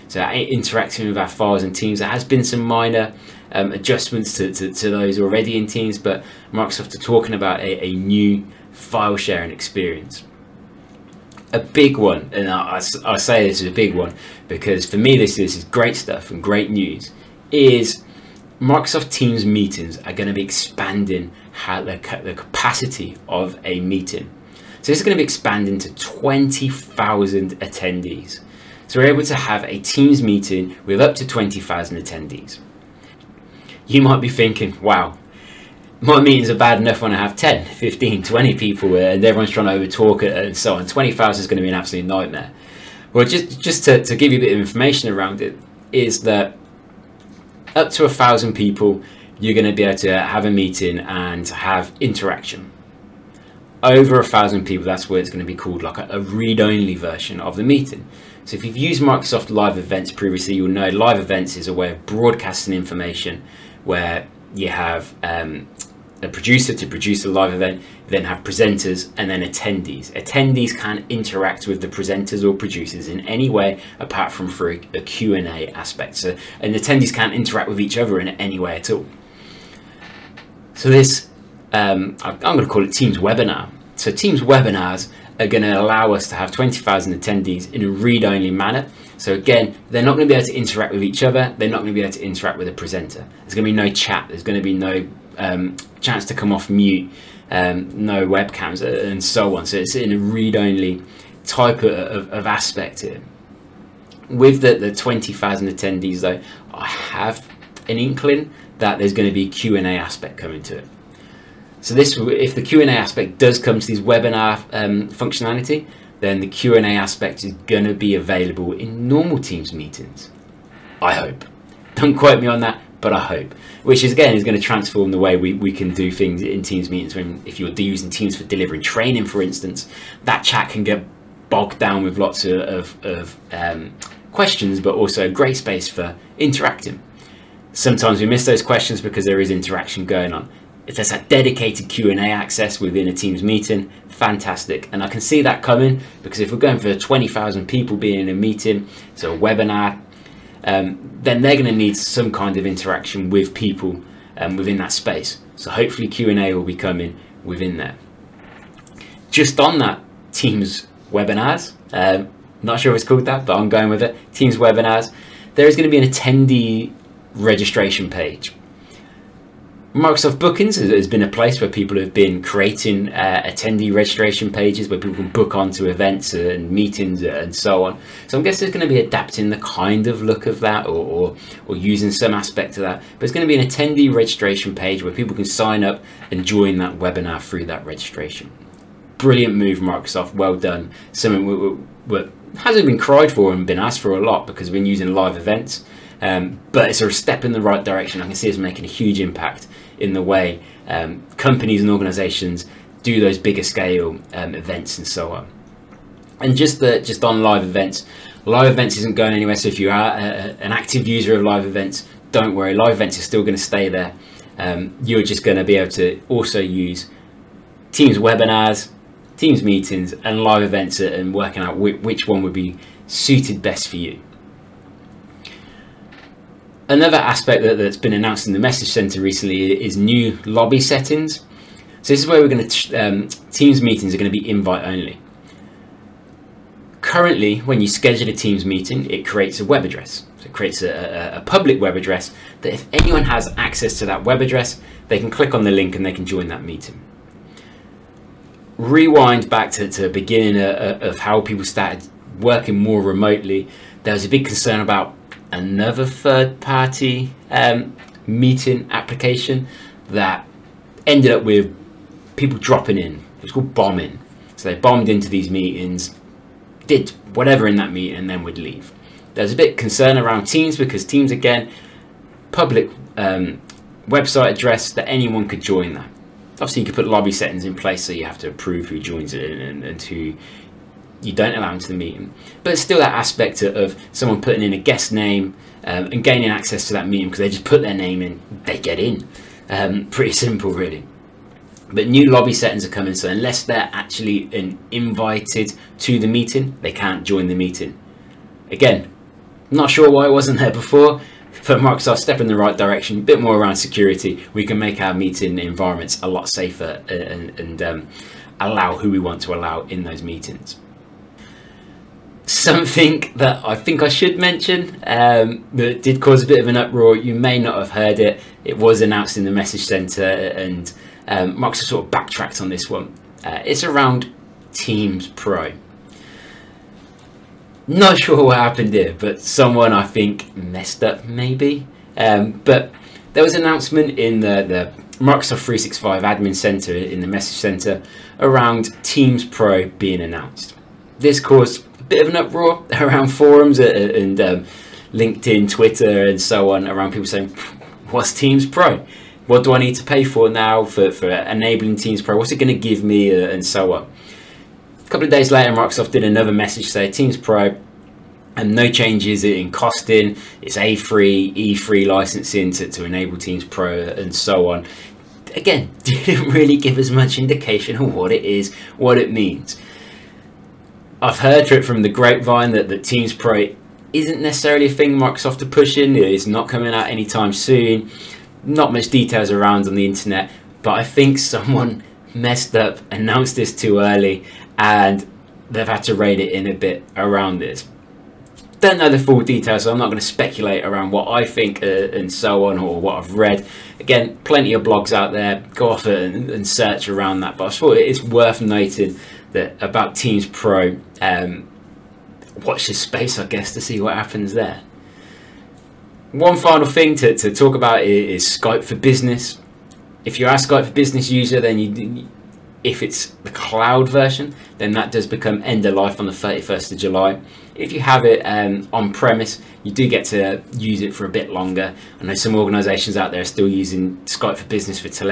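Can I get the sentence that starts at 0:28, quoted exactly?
So we're able to have a Teams meeting with up to 20,000 attendees.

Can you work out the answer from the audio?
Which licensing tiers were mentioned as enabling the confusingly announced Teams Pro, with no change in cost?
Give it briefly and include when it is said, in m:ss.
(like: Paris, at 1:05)
A3, E3, at 6:00.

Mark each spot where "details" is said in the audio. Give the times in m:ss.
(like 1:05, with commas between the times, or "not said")
6:19, 6:29.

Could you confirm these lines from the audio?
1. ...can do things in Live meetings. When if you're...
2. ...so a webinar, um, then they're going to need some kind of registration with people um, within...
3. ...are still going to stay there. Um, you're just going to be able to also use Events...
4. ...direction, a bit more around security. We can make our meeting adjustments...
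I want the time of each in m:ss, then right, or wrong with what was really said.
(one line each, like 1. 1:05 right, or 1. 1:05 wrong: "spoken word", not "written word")
1. 2:05 wrong: "Teams", not "Live"
2. 2:29 wrong: "interaction", not "registration"
3. 3:33 wrong: "Teams", not "Events"
4. 5:02 wrong: "environments", not "adjustments".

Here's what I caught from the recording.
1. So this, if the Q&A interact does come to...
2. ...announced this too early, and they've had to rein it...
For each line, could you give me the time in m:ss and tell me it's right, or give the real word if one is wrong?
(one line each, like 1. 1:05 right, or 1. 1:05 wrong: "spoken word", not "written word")
1. 1:51 wrong: "aspect", not "interact"
2. 6:23 right.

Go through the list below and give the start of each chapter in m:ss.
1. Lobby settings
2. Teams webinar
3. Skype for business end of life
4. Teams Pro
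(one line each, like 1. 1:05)
1. 3:48
2. 0:12
3. 6:48
4. 5:23.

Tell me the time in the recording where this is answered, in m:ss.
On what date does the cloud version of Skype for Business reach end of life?
6:56.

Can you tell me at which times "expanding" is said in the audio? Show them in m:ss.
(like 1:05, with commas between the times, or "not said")
0:20, 0:25.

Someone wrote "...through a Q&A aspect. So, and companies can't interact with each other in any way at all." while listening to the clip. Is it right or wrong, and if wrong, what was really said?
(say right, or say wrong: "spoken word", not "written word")
wrong: "attendees", not "companies".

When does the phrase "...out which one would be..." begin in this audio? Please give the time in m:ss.
3:41.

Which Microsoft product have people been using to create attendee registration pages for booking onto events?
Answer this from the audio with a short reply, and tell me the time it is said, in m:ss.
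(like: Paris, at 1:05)
Microsoft Bookings, at 2:49.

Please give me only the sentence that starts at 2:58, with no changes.
So I'm guessing it's going to be adapting the kind of look of that or, or, or using some aspect of that.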